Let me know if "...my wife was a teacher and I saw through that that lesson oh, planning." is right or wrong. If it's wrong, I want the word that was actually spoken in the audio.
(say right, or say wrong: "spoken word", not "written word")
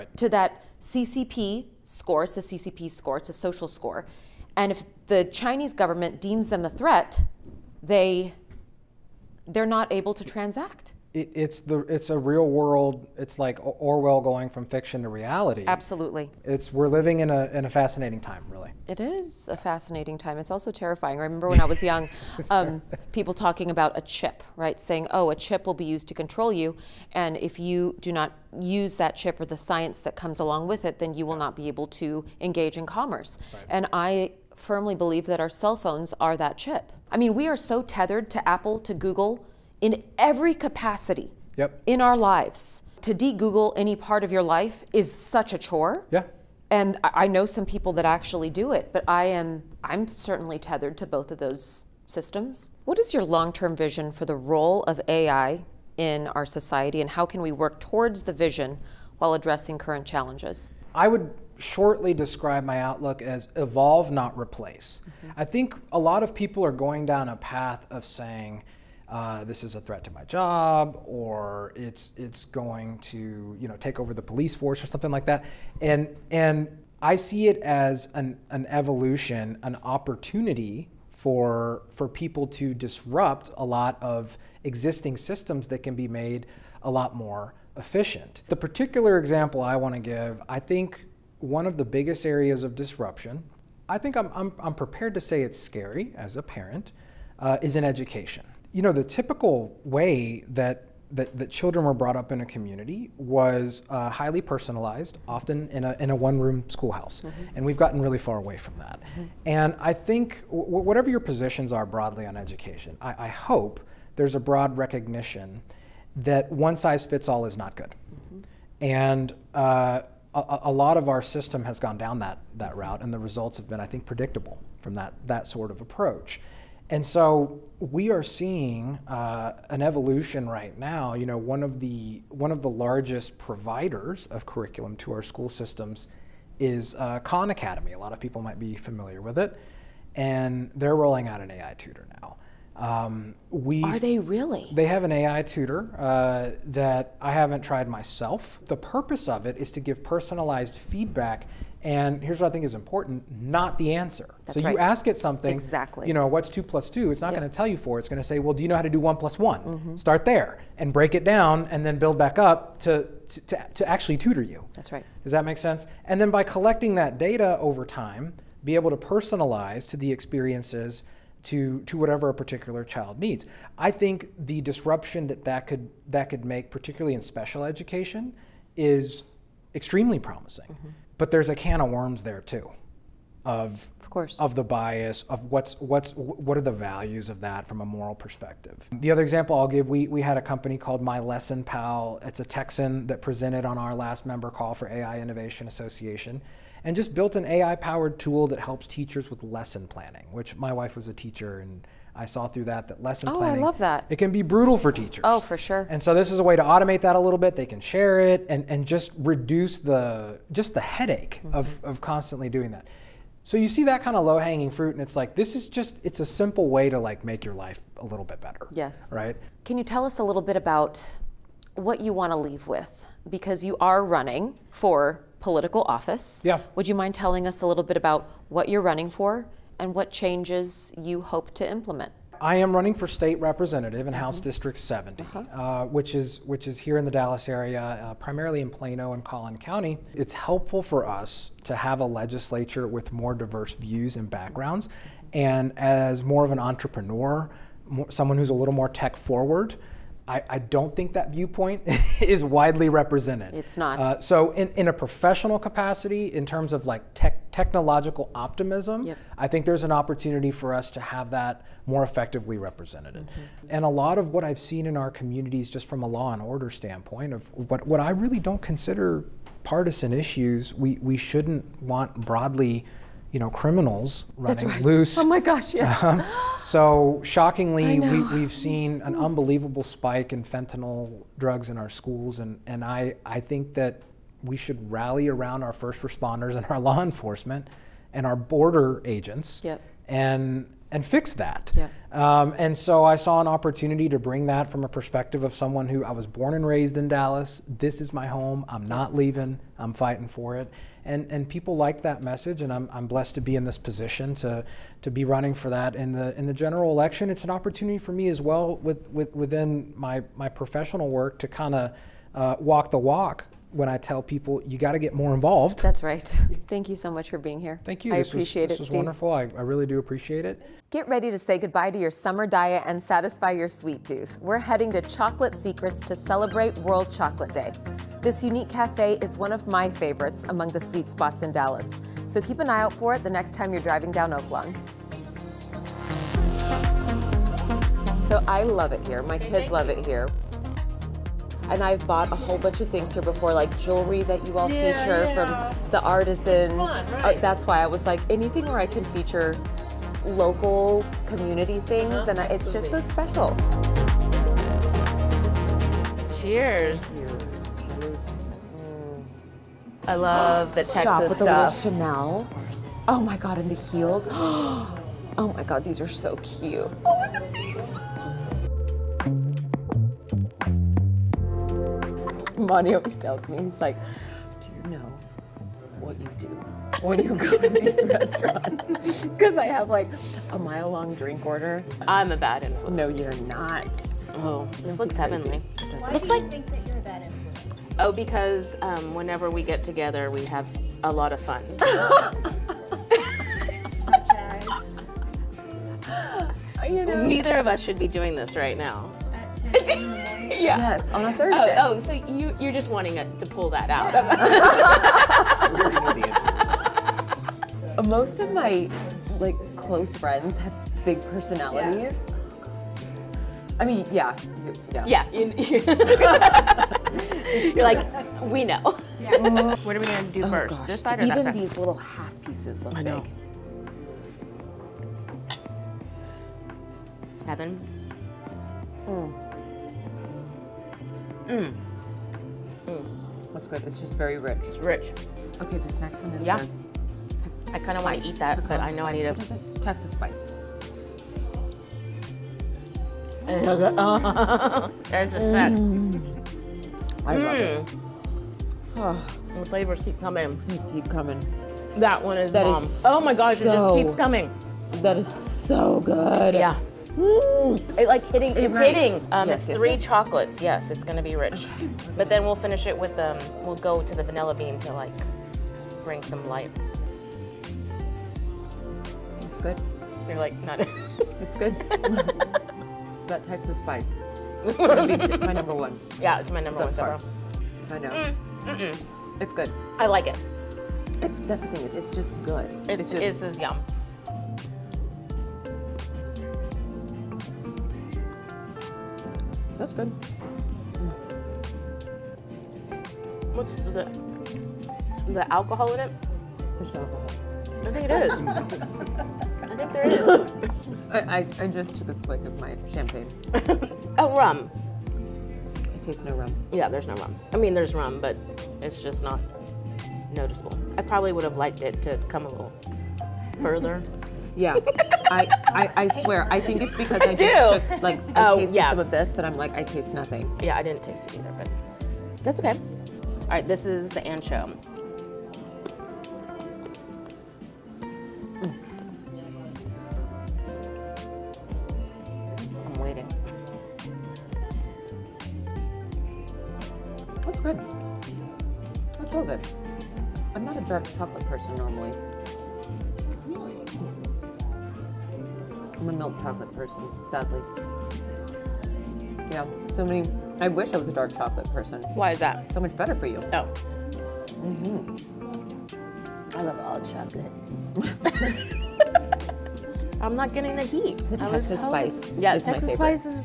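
right.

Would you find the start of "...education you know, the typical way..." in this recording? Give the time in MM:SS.
01:37.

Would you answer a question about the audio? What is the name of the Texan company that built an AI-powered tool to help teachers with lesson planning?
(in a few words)
My Lesson Pal.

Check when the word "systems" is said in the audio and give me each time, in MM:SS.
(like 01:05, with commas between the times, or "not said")
00:52, 01:25, 02:01, 02:15.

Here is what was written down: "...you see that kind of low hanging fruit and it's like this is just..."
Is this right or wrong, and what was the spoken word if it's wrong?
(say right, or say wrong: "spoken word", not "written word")
right.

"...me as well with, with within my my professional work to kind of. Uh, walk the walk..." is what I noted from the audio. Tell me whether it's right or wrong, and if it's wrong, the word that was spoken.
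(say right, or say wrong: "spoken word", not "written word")
right.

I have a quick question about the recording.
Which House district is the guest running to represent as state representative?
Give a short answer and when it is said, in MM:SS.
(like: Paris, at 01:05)
District 70, at 03:54.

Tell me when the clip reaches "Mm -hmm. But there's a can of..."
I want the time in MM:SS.
03:00.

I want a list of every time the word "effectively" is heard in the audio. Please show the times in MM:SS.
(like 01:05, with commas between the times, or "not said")
04:22.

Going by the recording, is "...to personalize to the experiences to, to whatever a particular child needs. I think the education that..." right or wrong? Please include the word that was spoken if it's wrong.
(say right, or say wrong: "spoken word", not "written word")
wrong: "disruption", not "education".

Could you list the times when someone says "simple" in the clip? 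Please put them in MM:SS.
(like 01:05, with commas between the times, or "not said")
03:36.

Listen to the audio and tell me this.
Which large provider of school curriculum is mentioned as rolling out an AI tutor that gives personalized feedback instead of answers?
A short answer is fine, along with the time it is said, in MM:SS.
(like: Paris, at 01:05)
Khan Academy, at 02:17.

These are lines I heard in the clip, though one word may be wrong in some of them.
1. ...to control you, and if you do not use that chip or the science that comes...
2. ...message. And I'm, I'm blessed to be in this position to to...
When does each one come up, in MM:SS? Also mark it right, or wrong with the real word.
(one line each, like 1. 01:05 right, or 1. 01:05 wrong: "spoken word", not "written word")
1. 00:26 right
2. 05:02 right.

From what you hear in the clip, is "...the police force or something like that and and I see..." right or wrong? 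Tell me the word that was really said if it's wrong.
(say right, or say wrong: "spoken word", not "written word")
right.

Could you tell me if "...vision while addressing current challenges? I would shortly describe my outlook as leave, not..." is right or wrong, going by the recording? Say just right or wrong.
wrong.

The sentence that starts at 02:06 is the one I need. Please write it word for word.
And so we are seeing uh, an evolution right now.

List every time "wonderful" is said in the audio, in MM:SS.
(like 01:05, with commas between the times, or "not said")
05:18.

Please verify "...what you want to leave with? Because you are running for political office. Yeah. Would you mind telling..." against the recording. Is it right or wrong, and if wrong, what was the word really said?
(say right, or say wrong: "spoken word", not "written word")
right.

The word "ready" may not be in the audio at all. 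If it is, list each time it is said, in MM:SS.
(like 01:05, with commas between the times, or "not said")
05:21.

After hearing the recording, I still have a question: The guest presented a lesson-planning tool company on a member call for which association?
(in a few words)
AI Innovation Association.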